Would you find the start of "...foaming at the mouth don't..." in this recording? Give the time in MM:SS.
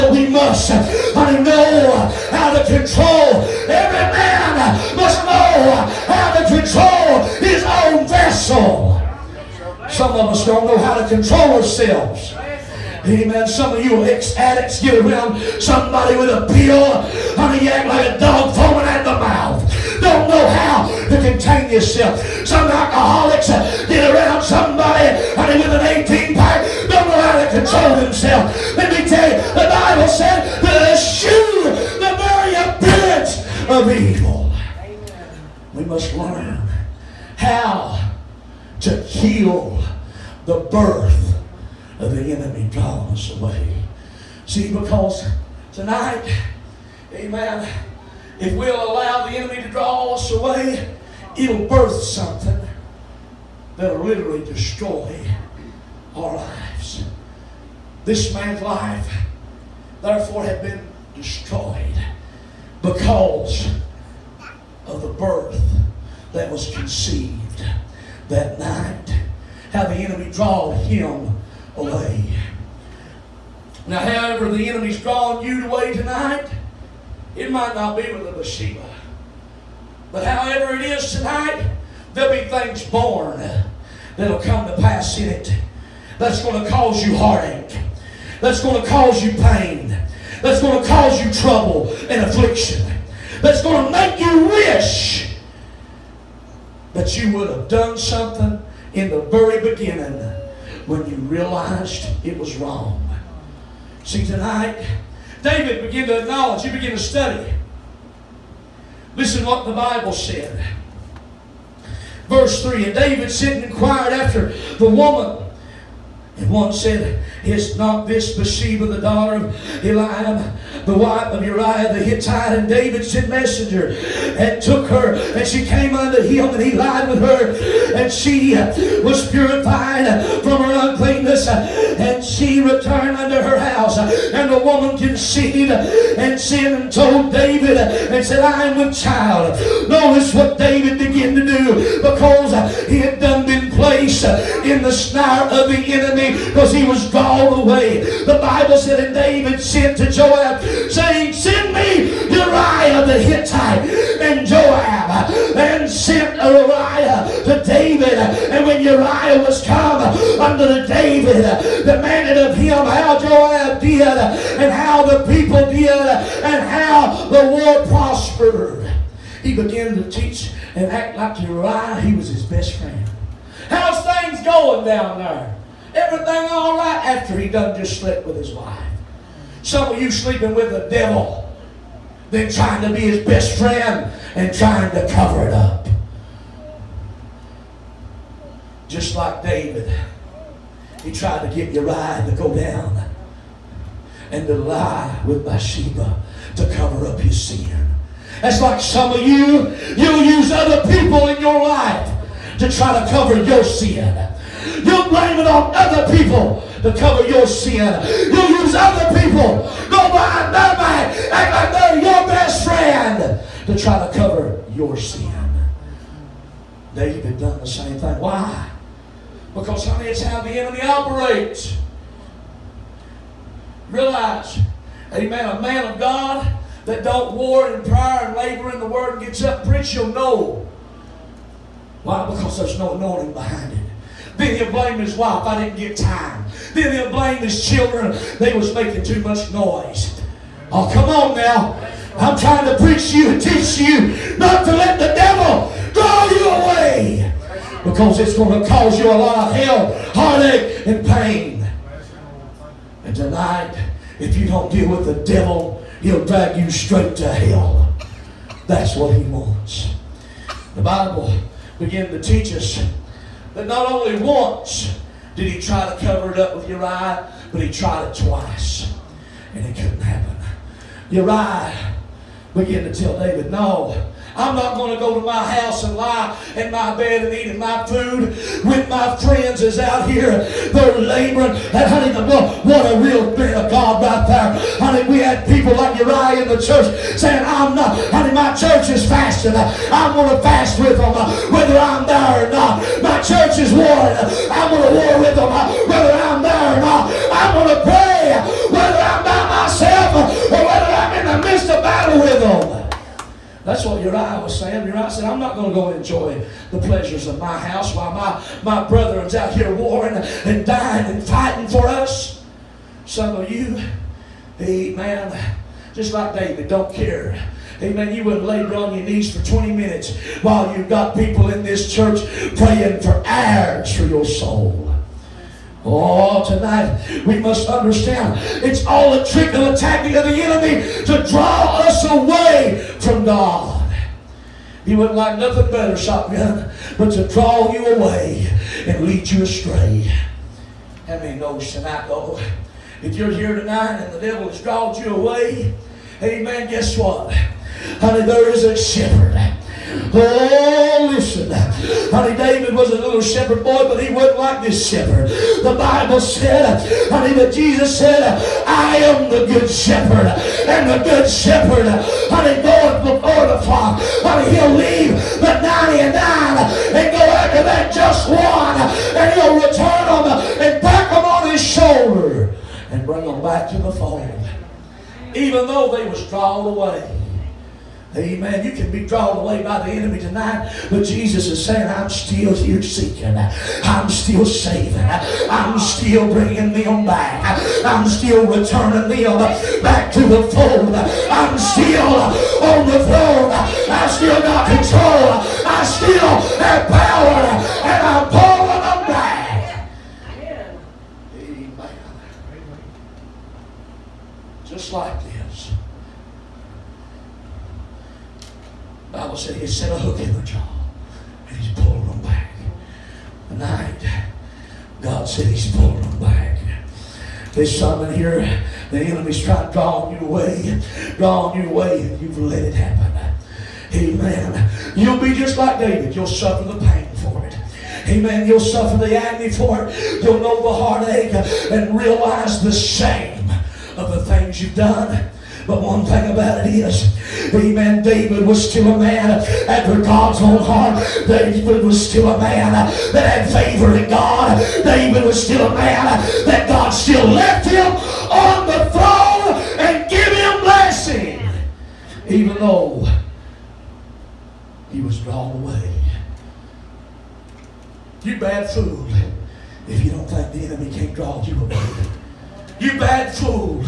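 00:18.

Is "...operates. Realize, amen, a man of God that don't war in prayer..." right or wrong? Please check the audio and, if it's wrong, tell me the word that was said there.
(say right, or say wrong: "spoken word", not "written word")
right.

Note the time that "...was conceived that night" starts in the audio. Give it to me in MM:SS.
01:06.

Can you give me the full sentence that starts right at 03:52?
Because there's no anointing behind it.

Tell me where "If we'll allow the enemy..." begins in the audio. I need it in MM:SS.
00:48.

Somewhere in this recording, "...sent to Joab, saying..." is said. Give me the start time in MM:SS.
02:29.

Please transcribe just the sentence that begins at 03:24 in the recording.
You blame it on other people to cover your sin.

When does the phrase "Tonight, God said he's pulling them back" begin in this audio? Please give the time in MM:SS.
06:53.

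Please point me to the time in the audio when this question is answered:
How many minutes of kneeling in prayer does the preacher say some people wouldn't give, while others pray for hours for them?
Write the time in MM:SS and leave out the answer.
05:19.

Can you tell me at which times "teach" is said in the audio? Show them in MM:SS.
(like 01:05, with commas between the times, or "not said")
02:50, 04:03, 04:22.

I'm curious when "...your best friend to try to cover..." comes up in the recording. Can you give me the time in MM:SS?
03:32.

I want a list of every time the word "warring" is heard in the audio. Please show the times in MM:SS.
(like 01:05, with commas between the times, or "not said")
04:53, 05:09.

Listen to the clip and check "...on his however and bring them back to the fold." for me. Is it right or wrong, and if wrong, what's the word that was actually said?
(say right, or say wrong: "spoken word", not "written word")
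wrong: "shoulder", not "however".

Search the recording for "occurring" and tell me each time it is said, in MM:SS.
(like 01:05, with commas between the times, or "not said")
not said.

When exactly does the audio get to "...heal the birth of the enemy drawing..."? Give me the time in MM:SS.
00:39.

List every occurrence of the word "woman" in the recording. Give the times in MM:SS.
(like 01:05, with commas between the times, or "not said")
01:54, 02:14.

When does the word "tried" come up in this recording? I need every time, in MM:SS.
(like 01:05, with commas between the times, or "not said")
03:11, 04:27.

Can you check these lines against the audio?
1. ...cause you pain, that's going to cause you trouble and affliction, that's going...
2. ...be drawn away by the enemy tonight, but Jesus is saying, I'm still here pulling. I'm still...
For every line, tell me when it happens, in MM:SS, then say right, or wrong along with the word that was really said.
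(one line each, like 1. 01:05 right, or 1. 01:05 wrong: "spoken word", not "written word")
1. 01:28 right
2. 06:18 wrong: "seeking", not "pulling".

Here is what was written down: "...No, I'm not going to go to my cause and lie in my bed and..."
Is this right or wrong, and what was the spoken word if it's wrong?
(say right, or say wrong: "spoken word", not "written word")
wrong: "house", not "cause".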